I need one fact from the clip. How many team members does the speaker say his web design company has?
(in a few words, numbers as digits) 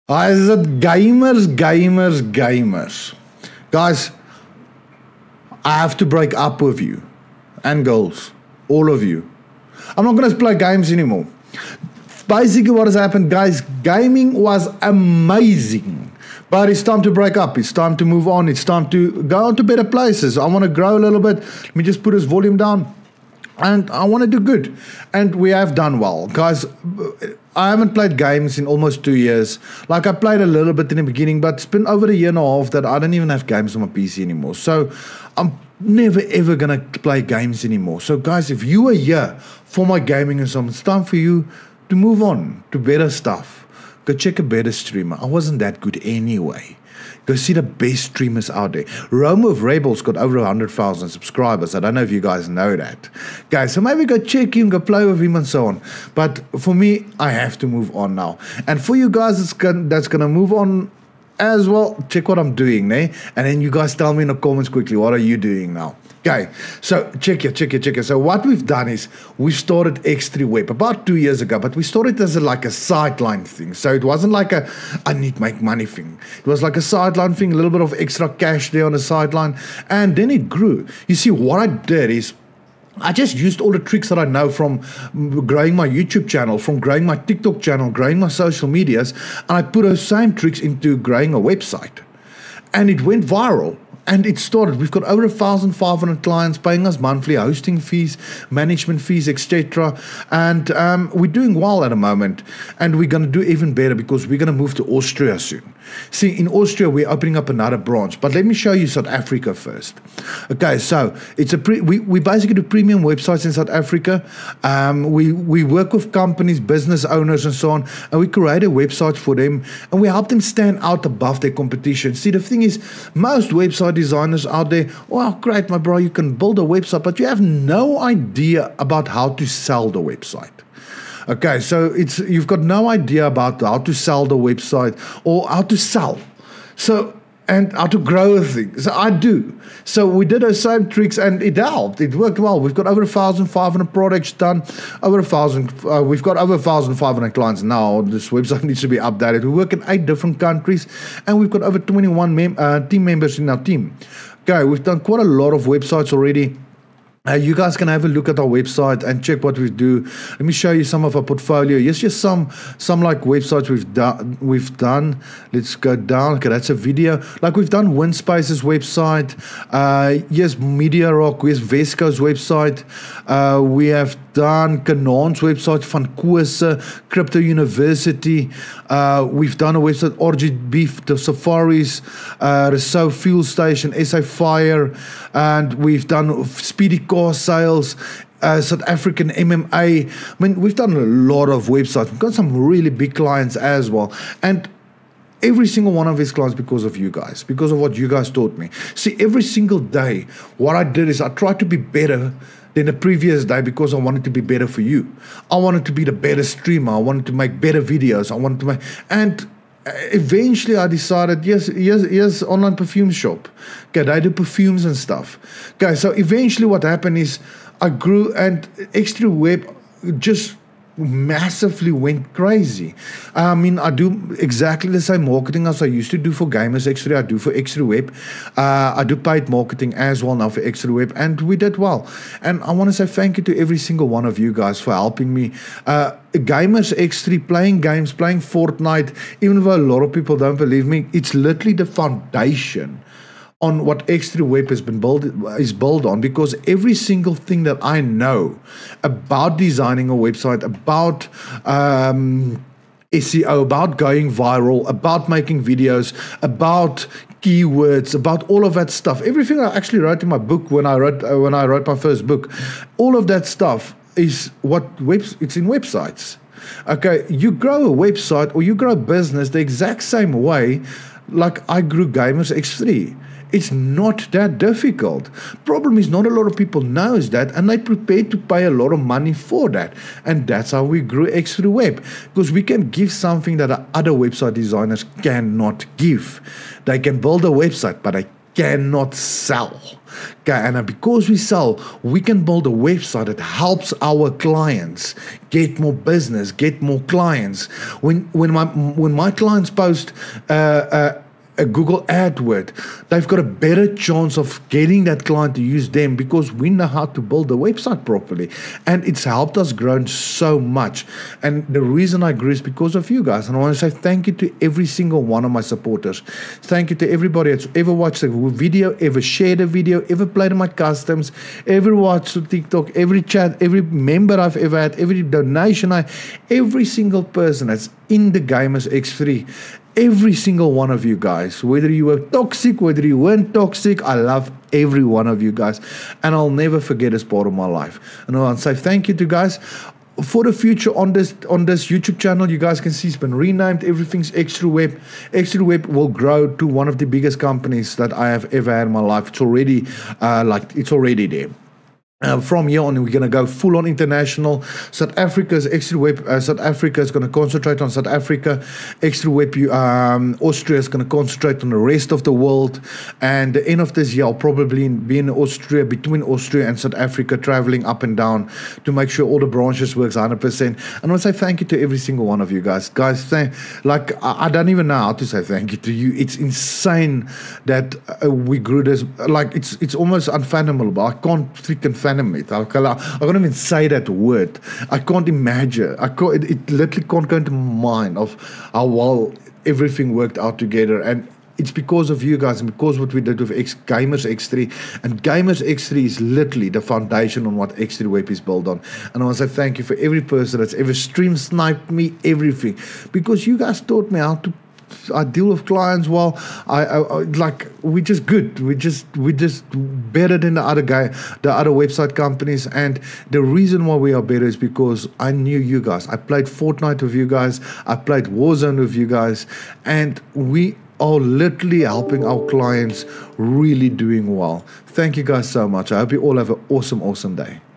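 21.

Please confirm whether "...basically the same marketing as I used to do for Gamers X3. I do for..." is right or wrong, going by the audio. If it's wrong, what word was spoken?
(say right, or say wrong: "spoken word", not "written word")
wrong: "exactly", not "basically".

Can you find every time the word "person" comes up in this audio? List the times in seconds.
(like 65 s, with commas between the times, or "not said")
327 s, 400 s.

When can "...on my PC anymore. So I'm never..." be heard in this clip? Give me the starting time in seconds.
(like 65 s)
33 s.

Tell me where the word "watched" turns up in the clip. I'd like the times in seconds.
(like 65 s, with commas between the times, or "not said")
317 s, 321 s.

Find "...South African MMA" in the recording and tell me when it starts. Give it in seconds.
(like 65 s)
188 s.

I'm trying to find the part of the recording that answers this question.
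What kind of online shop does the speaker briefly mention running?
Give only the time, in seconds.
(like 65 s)
212 s.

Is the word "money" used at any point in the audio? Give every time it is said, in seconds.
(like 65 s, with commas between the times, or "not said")
75 s, 278 s.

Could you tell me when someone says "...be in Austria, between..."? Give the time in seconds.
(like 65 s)
364 s.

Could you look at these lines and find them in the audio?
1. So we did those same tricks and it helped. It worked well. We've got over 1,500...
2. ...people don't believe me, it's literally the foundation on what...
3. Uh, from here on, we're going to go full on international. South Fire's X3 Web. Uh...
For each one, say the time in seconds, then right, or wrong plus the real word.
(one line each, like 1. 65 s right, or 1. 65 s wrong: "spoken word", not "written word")
1. 139 s right
2. 240 s right
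3. 352 s wrong: "Africa", not "Fire".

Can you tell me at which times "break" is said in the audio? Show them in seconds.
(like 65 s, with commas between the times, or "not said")
6 s, 17 s.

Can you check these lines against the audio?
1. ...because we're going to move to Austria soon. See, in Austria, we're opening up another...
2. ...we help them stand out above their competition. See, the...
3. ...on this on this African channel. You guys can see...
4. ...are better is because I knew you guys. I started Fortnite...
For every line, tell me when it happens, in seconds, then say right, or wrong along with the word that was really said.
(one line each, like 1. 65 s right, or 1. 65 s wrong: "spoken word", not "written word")
1. 103 s right
2. 120 s right
3. 340 s wrong: "YouTube", not "African"
4. 414 s wrong: "played", not "started".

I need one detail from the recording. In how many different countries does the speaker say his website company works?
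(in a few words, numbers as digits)
8.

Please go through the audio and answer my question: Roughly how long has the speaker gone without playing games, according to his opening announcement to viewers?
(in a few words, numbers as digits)
almost two years.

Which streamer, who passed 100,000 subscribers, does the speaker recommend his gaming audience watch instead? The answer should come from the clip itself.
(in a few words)
Rome of Rebels.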